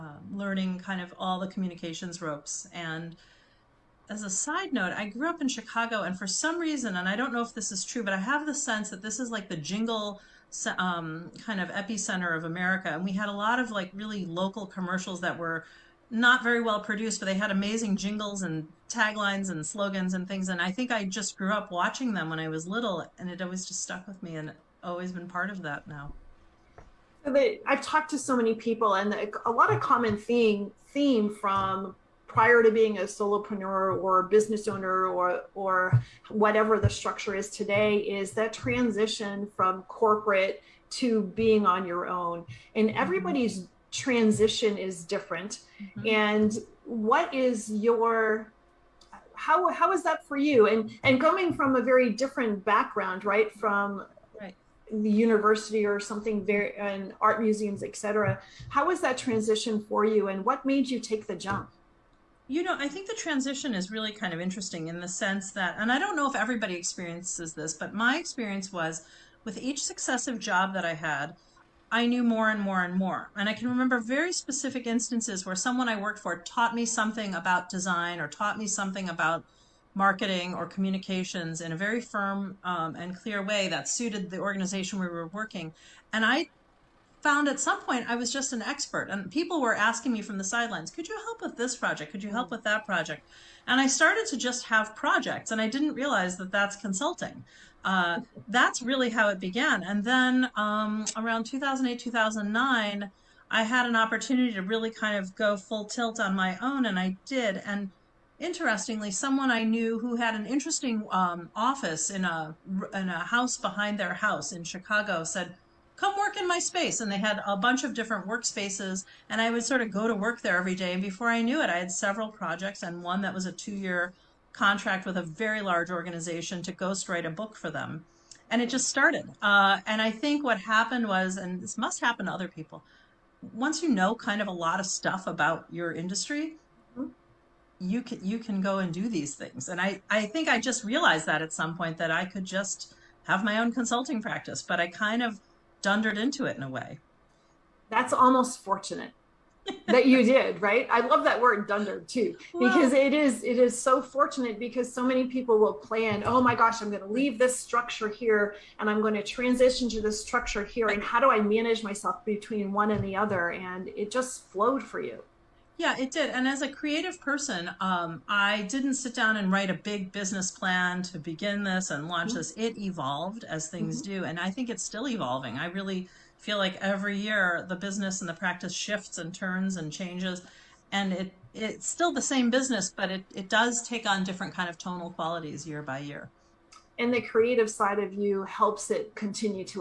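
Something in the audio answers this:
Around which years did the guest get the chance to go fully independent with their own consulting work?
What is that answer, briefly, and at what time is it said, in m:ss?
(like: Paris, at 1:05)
2008, 2009, at 1:41.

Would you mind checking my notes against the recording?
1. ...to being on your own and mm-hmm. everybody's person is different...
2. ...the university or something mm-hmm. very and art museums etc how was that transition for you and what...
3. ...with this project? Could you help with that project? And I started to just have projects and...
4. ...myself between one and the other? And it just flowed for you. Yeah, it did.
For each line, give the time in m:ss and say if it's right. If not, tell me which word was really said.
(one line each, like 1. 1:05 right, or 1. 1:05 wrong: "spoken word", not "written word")
1. 0:40 wrong: "transition", not "person"
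2. 0:54 right
3. 1:31 right
4. 2:41 right.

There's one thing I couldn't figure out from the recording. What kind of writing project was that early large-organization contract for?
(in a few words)
ghostwrite a book.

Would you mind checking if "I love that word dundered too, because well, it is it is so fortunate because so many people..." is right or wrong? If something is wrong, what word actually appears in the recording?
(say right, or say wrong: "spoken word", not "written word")
right.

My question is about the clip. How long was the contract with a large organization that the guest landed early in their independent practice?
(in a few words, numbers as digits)
two year.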